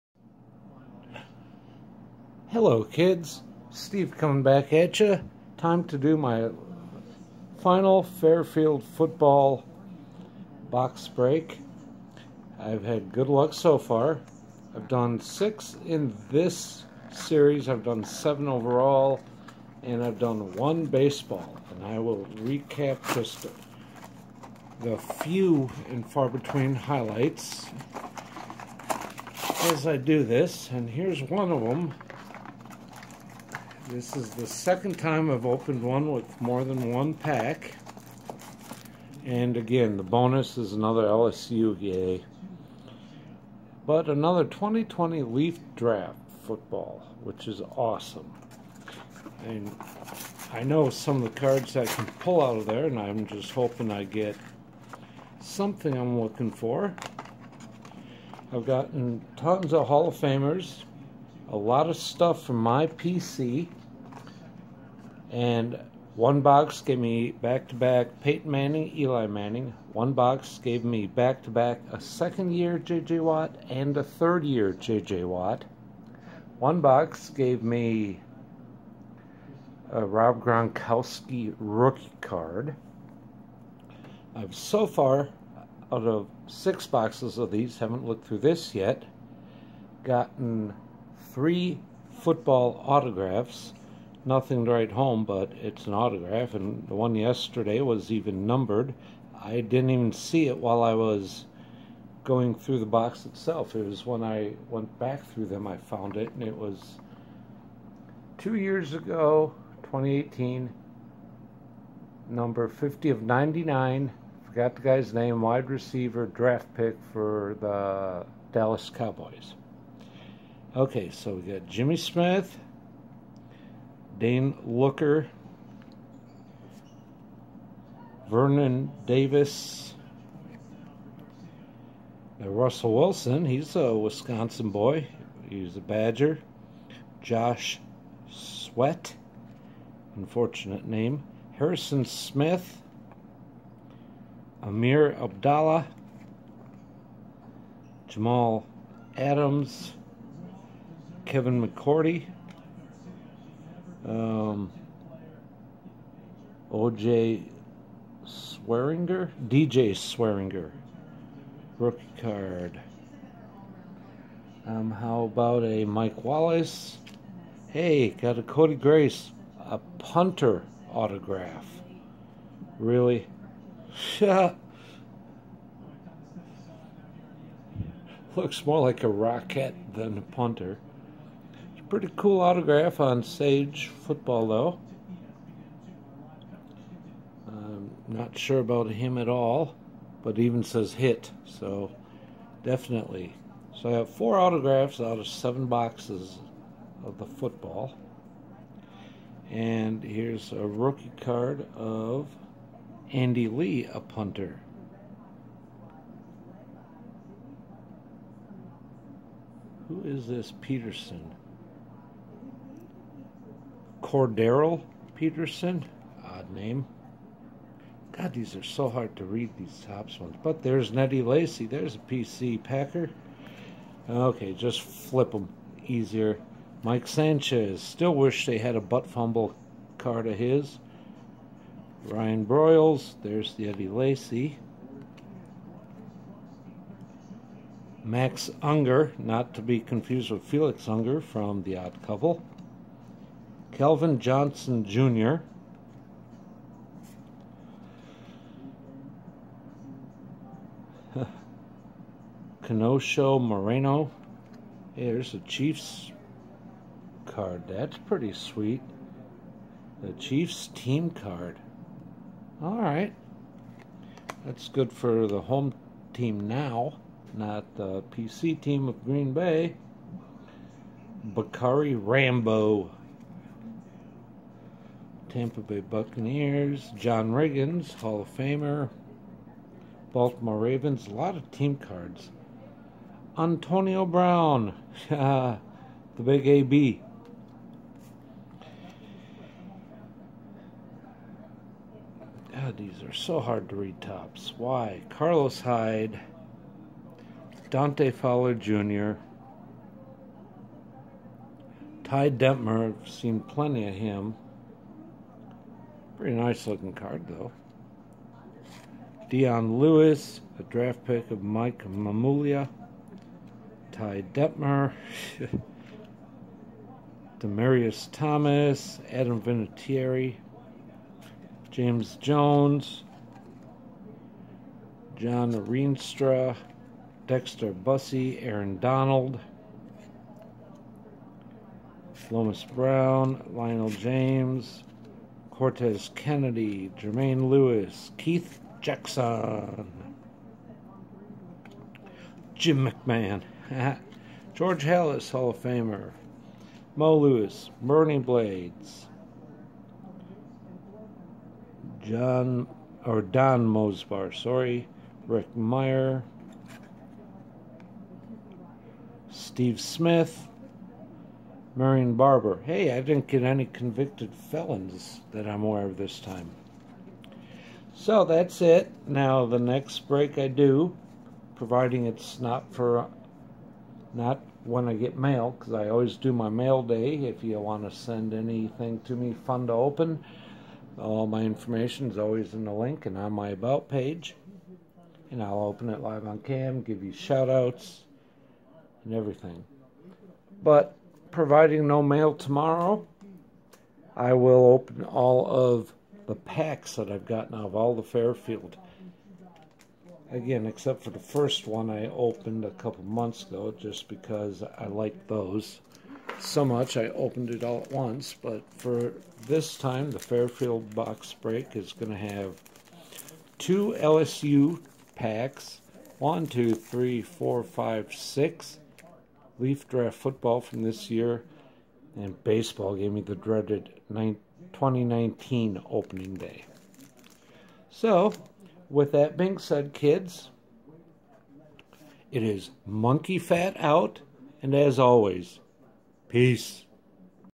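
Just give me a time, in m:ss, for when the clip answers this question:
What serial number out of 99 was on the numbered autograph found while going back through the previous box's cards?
1:52.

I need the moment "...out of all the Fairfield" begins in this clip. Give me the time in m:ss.
6:37.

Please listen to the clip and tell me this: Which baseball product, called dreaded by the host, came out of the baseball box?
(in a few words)
2019 Opening Day.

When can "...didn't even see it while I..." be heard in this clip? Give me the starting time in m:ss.
1:39.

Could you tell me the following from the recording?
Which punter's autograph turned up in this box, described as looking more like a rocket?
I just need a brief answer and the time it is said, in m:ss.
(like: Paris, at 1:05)
Cody Grace, at 2:48.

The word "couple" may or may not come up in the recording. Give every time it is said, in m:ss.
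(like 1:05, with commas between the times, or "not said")
4:02, 6:42.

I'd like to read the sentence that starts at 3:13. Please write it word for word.
So I have four autographs out of seven boxes of the football.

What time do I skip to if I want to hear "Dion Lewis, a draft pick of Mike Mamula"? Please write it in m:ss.
5:09.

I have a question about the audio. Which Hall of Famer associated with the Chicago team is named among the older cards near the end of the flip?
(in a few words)
George Halas.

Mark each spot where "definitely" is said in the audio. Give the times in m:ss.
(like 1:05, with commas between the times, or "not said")
3:12.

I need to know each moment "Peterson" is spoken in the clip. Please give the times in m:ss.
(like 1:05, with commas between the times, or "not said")
3:30, 3:35.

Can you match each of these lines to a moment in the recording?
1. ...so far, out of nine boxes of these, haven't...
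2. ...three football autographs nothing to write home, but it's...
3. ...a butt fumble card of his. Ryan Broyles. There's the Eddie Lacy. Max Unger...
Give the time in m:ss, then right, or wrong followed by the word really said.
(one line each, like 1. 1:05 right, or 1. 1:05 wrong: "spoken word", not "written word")
1. 1:24 wrong: "six", not "nine"
2. 1:31 right
3. 3:48 right.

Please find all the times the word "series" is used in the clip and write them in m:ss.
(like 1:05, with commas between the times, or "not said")
0:17.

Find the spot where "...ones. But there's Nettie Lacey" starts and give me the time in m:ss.
3:40.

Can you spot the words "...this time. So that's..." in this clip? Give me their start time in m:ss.
6:05.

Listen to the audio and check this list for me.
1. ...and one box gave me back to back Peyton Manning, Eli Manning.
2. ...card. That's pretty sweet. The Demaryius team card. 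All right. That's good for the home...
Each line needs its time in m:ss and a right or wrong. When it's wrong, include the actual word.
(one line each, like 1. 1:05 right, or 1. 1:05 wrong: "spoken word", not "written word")
1. 1:05 right
2. 4:17 wrong: "Chiefs", not "Demaryius".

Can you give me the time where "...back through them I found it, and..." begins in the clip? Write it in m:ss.
1:44.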